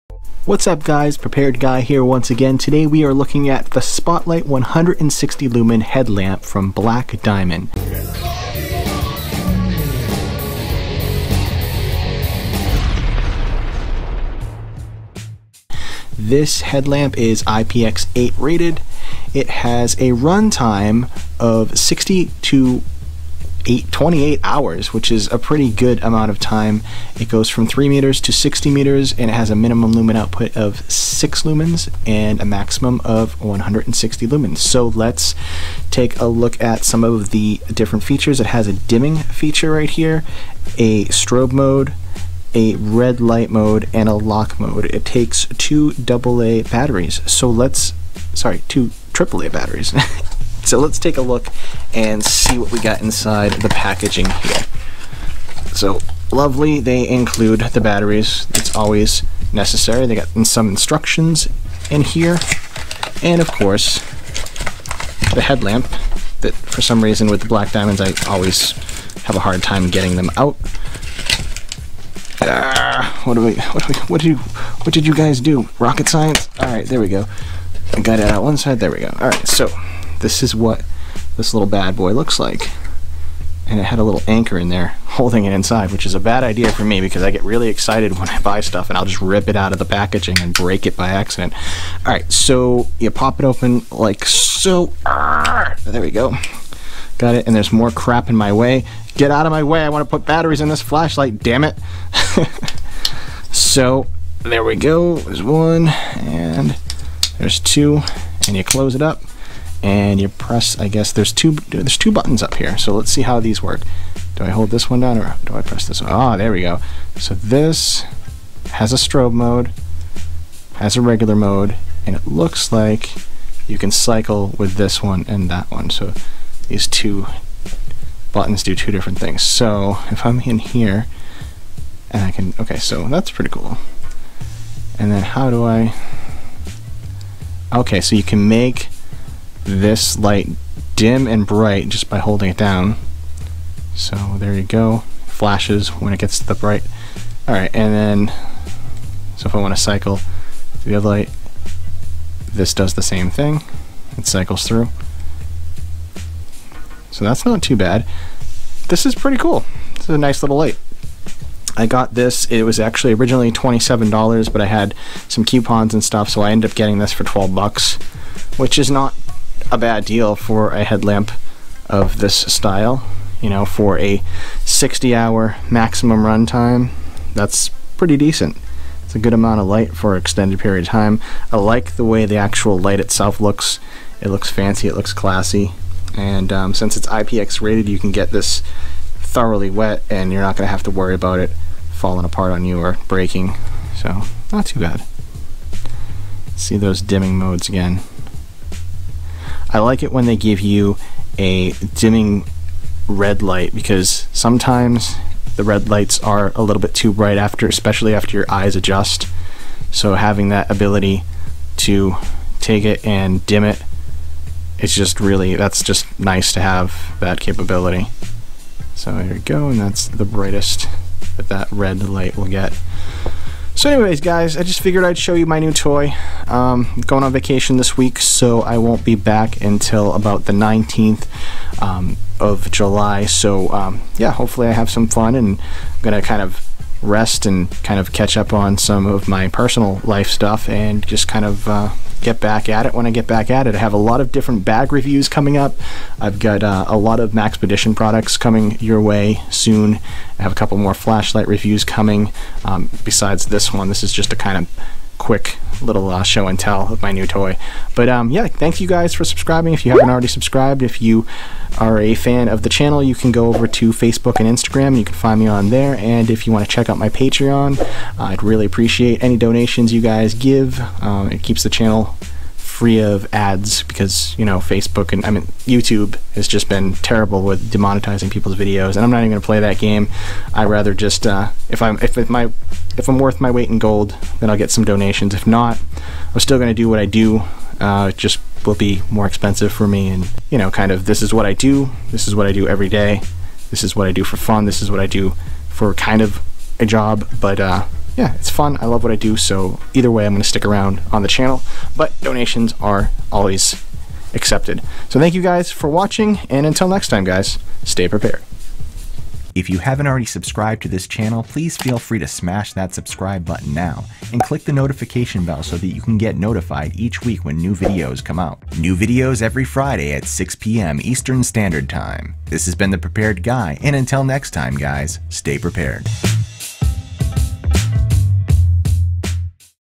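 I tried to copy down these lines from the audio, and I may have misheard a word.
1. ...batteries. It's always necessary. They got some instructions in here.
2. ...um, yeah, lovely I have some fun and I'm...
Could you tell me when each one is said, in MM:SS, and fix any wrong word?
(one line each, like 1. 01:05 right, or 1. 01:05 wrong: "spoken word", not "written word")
1. 00:57 right
2. 03:53 wrong: "hopefully", not "lovely".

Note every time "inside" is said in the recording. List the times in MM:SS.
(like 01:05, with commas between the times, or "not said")
00:53, 01:25.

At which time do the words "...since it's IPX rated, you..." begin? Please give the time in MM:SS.
03:06.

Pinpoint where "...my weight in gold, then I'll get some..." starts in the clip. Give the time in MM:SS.
04:43.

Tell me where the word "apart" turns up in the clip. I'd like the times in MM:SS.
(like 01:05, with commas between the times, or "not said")
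03:12.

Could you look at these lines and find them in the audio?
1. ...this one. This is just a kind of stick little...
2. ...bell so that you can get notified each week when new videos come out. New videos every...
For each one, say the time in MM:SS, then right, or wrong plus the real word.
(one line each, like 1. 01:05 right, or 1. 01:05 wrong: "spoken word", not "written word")
1. 04:13 wrong: "quick", not "stick"
2. 05:15 right.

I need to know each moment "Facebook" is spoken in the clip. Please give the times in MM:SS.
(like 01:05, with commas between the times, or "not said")
04:23, 04:34.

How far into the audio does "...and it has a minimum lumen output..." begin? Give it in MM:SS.
00:29.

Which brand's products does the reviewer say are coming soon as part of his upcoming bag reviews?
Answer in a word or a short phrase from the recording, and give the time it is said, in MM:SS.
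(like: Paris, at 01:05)
Maxpedition, at 04:07.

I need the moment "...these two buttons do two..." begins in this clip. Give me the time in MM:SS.
02:06.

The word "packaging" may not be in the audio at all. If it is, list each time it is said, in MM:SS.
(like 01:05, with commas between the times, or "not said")
00:53, 01:29.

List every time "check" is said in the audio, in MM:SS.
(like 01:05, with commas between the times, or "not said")
04:26.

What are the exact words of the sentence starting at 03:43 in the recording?
So anyways, guys, I just figured I'd show you my new toy.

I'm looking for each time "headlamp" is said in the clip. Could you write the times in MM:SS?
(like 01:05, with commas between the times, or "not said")
00:05, 00:16, 01:05, 02:50.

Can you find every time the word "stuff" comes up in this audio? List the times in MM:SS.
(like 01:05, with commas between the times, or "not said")
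01:28, 02:46, 04:00.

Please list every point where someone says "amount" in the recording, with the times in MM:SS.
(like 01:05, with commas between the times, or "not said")
00:26, 02:59.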